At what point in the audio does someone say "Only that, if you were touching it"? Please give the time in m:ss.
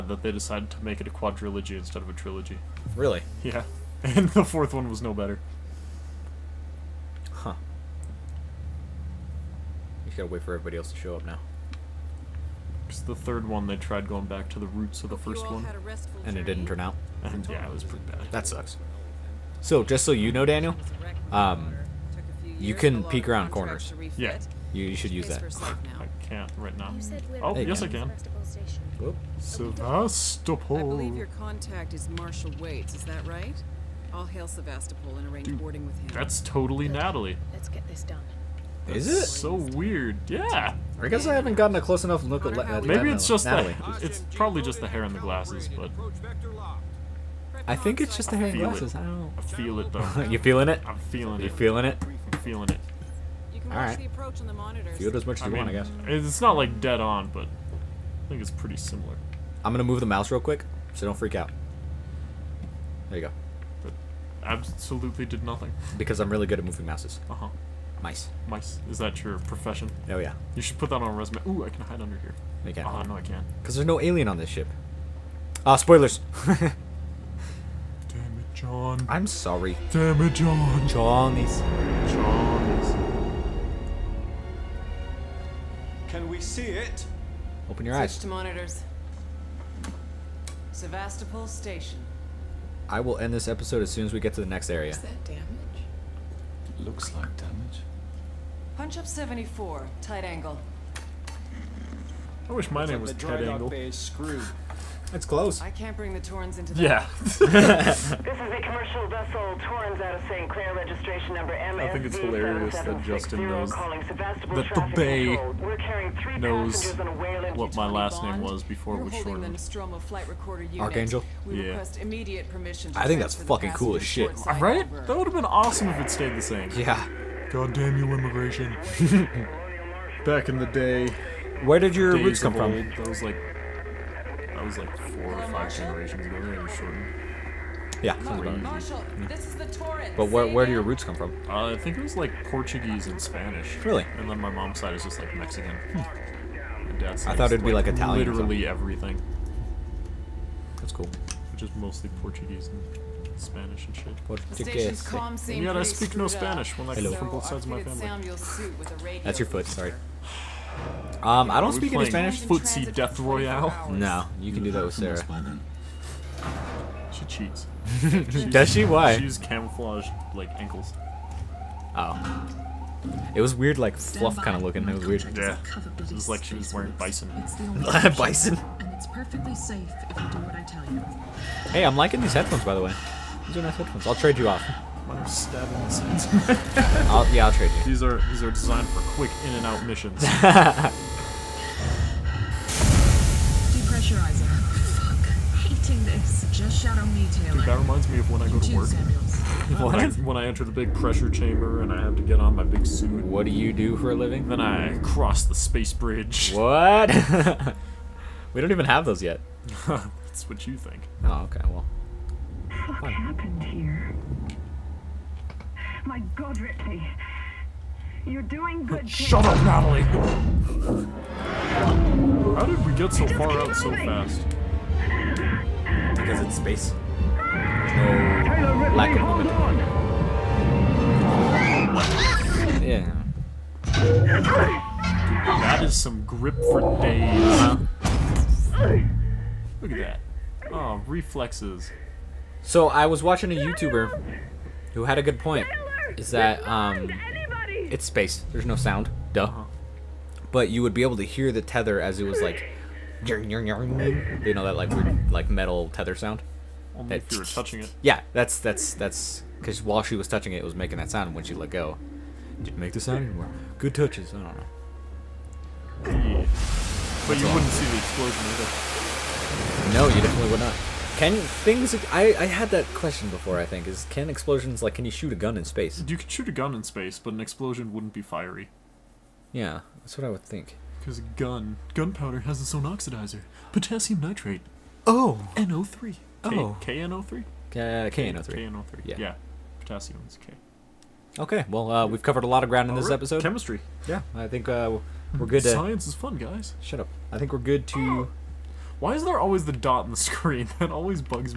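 4:16.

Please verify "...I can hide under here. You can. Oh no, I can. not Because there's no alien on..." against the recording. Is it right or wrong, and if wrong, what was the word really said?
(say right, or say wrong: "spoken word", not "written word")
right.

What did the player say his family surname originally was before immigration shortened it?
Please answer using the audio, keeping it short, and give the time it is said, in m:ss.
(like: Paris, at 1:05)
Archangel, at 2:00.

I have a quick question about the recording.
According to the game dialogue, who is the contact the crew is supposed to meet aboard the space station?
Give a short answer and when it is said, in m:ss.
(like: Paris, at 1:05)
Marshal Waits, at 0:32.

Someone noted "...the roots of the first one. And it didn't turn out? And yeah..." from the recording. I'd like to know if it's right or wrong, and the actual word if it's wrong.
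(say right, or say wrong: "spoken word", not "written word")
right.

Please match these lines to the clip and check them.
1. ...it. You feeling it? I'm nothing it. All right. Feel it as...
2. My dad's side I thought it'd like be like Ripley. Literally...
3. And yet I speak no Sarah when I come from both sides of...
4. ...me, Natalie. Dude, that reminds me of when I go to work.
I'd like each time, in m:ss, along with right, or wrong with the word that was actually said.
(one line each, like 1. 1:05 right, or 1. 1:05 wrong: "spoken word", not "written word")
1. 0:51 wrong: "feeling", not "nothing"
2. 2:25 wrong: "Italian", not "Ripley"
3. 2:35 wrong: "Spanish", not "Sarah"
4. 3:17 wrong: "Taylor", not "Natalie".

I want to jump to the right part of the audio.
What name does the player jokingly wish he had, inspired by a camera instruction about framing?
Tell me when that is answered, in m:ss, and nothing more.
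1:43.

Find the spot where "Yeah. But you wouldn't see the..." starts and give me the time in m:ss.
4:26.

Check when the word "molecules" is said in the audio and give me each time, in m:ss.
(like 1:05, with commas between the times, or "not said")
not said.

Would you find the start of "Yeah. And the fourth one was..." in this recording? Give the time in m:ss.
0:03.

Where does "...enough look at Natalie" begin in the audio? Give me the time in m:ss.
0:42.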